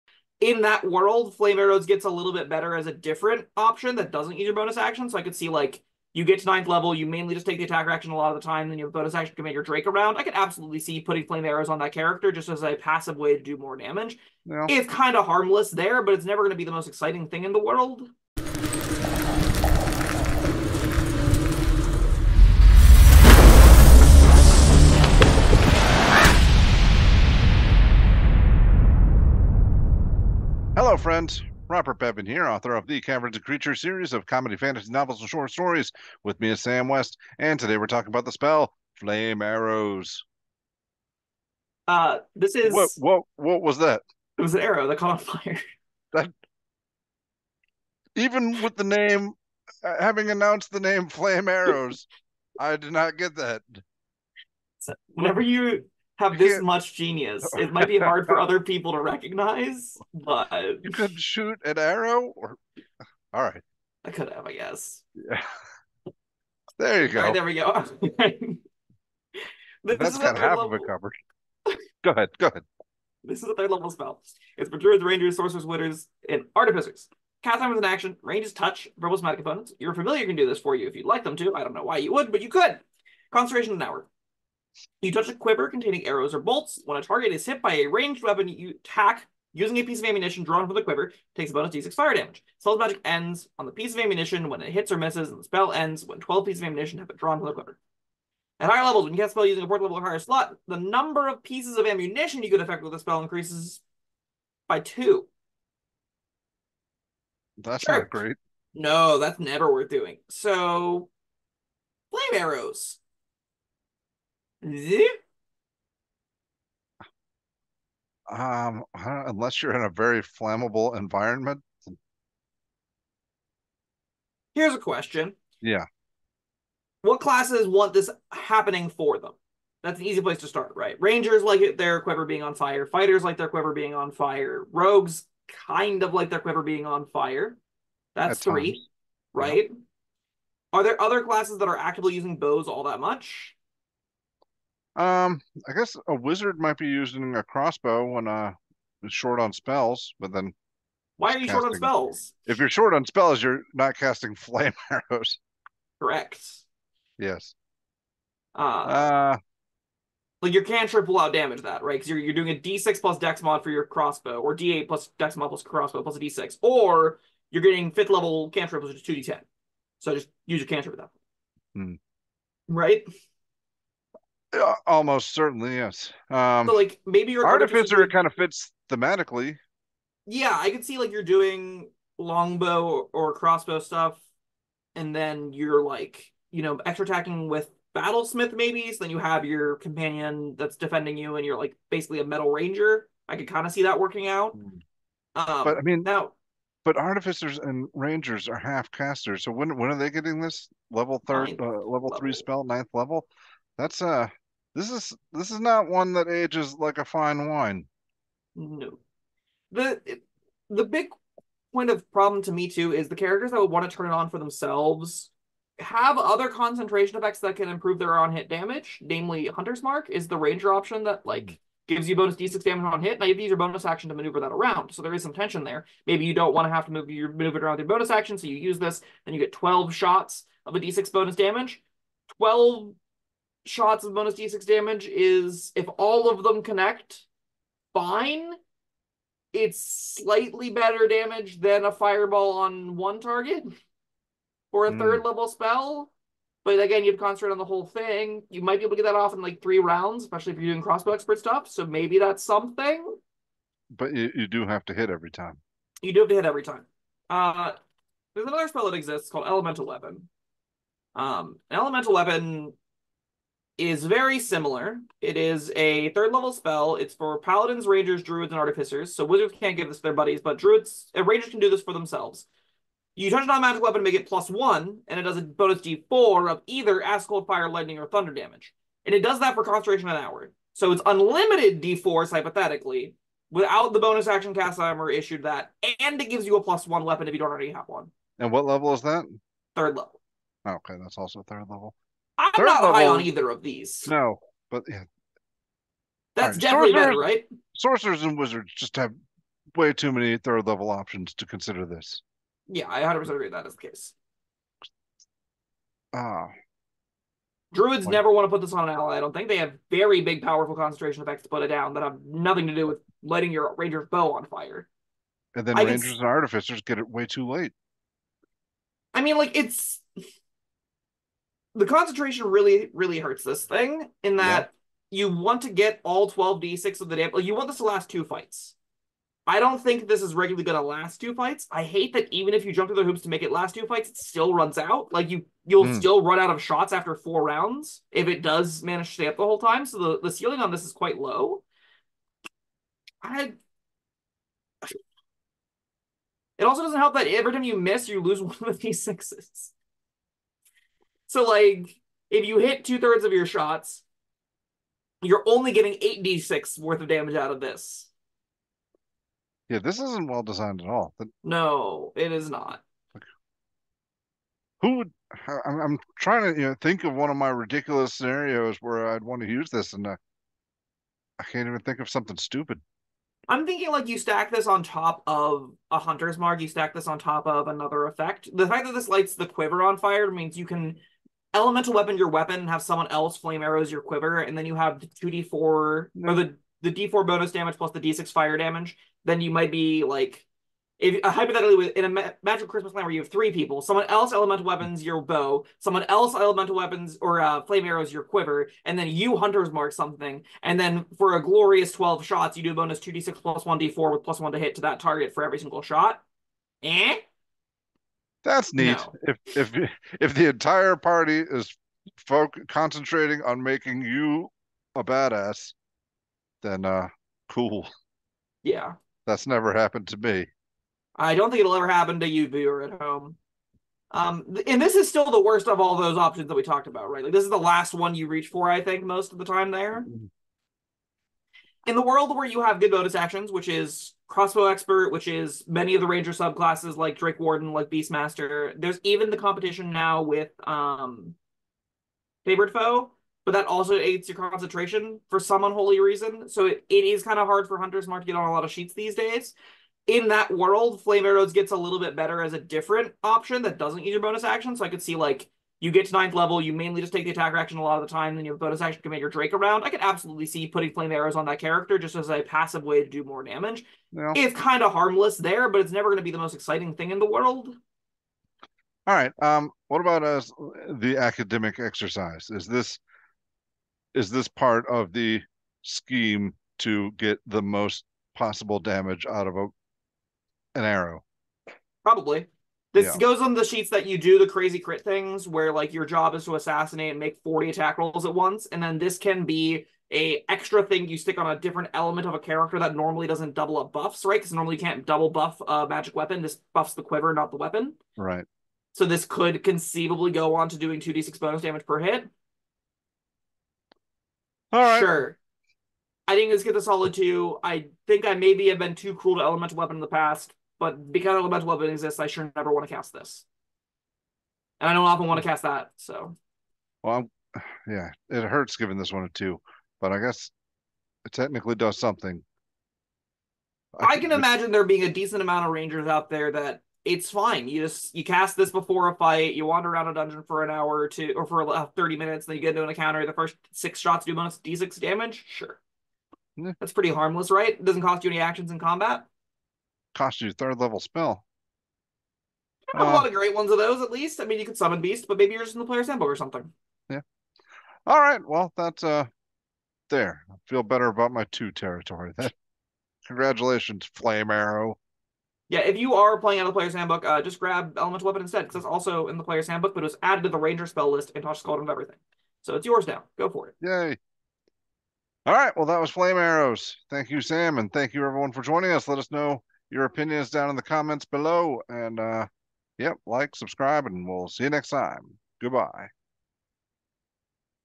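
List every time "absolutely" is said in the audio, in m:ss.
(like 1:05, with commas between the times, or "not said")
0:10, 7:40.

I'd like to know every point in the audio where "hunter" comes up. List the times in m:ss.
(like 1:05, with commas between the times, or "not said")
3:39, 6:15, 6:39, 7:27.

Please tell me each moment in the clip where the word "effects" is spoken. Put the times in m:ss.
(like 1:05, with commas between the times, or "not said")
3:37, 5:11, 6:18.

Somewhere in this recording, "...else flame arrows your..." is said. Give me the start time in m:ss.
6:23.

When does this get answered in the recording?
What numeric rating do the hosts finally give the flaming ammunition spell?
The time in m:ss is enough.
8:26.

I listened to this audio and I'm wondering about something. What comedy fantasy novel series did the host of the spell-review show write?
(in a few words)
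Caverns and Creatures.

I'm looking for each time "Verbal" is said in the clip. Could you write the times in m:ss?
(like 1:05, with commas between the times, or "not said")
1:18.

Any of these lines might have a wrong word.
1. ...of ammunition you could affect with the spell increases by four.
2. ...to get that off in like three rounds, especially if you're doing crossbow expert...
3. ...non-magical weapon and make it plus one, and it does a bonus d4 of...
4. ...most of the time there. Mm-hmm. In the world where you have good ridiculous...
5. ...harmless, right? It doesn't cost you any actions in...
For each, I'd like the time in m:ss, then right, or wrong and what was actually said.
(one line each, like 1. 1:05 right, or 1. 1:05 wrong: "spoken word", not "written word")
1. 1:41 wrong: "two", not "four"
2. 4:08 right
3. 4:33 right
4. 7:09 wrong: "bonus", not "ridiculous"
5. 8:57 right.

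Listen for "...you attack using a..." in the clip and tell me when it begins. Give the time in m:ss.
1:28.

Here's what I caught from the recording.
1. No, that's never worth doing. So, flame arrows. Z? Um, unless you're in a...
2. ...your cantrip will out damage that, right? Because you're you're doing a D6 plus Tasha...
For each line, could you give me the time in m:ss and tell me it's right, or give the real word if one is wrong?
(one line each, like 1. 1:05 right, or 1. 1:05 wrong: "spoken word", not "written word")
1. 1:48 right
2. 2:40 wrong: "Dex", not "Tasha".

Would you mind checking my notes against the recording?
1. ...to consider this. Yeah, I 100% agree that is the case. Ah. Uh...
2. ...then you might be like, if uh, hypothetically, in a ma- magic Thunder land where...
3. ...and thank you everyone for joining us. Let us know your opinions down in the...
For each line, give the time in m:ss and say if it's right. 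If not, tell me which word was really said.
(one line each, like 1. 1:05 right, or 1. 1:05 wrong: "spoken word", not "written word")
1. 5:01 right
2. 6:29 wrong: "Christmas", not "Thunder"
3. 9:27 right.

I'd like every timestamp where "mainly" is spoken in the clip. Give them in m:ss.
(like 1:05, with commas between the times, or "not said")
0:07, 7:36.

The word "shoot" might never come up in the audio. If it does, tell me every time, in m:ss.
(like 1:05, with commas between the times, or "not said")
1:01.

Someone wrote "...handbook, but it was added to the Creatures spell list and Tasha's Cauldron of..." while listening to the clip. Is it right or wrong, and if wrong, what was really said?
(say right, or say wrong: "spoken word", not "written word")
wrong: "Ranger", not "Creatures".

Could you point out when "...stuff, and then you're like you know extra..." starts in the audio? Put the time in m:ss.
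3:03.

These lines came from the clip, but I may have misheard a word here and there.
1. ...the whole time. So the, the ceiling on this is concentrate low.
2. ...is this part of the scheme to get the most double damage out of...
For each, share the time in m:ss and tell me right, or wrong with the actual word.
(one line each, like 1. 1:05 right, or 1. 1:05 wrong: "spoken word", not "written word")
1. 5:39 wrong: "quite", not "concentrate"
2. 7:54 wrong: "possible", not "double".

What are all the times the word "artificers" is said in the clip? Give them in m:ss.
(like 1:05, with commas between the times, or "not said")
1:16, 2:57, 3:16, 4:28, 5:16.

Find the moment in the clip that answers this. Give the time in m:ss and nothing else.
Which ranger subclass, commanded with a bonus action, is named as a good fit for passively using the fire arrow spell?
7:17.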